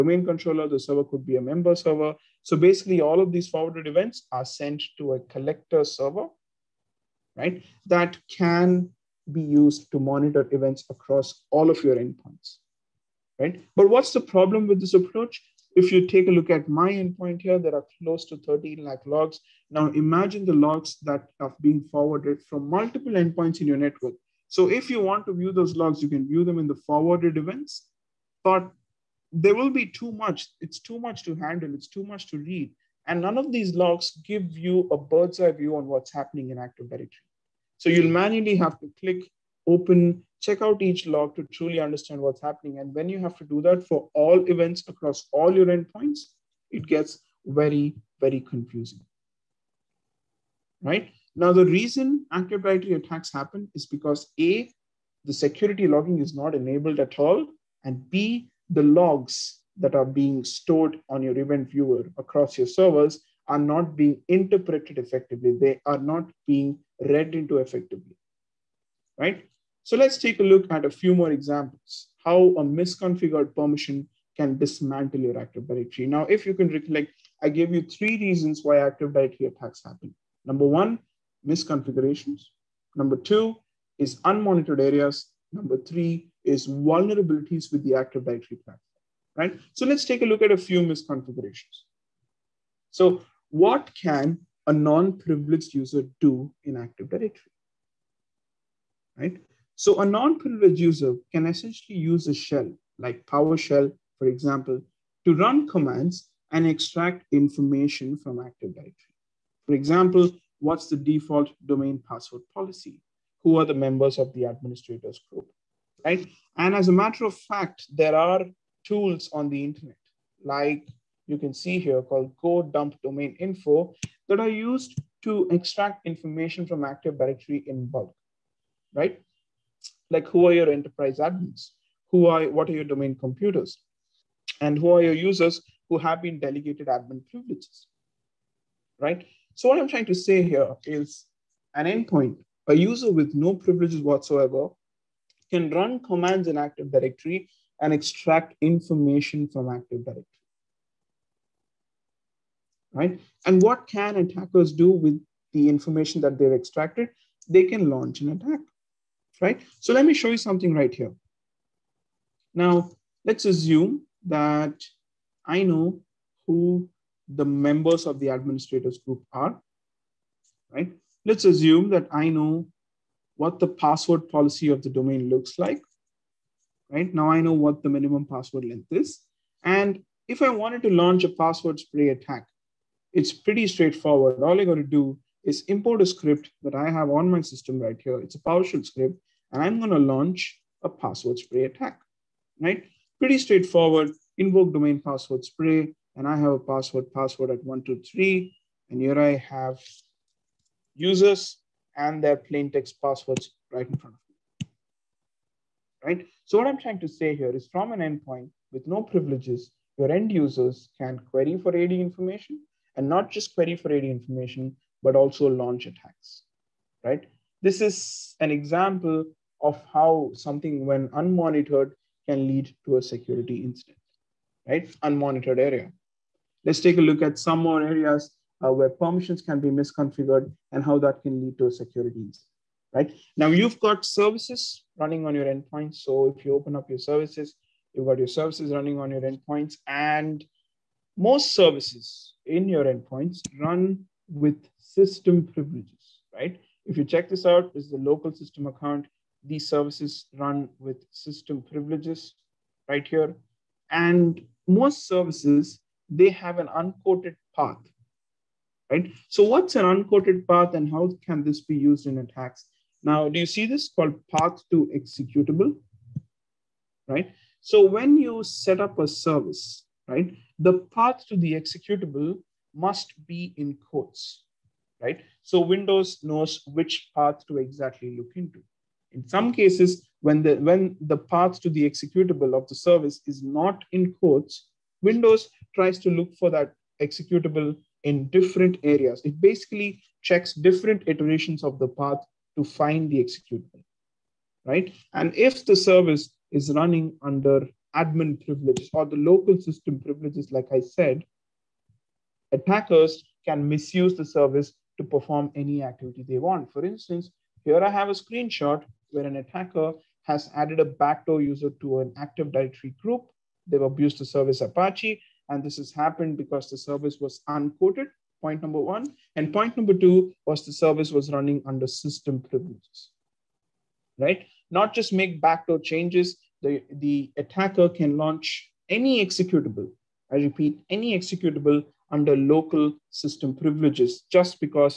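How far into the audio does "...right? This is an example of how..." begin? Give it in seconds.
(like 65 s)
217 s.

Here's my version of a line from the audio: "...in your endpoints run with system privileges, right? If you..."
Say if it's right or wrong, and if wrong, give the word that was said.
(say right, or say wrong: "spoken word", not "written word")
right.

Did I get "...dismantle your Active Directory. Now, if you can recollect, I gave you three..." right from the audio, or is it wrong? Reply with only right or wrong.
right.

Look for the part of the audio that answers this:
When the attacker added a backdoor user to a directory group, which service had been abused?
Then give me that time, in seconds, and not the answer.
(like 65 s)
314 s.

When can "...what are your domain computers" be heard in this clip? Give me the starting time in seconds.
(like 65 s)
132 s.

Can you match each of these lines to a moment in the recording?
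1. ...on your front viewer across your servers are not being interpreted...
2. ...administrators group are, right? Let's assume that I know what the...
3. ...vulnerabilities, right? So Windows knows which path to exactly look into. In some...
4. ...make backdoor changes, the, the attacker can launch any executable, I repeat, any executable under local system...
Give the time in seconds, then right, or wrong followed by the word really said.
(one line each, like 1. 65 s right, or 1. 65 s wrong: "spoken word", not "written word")
1. 61 s wrong: "event", not "front"
2. 168 s right
3. 273 s wrong: "quotes", not "vulnerabilities"
4. 325 s right.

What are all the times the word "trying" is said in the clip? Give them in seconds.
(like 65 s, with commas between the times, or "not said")
139 s, 206 s.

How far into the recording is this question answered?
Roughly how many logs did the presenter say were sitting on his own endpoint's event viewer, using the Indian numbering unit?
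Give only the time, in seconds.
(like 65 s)
18 s.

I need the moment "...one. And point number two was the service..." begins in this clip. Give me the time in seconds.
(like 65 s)
318 s.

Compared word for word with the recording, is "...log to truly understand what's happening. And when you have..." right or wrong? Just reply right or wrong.
right.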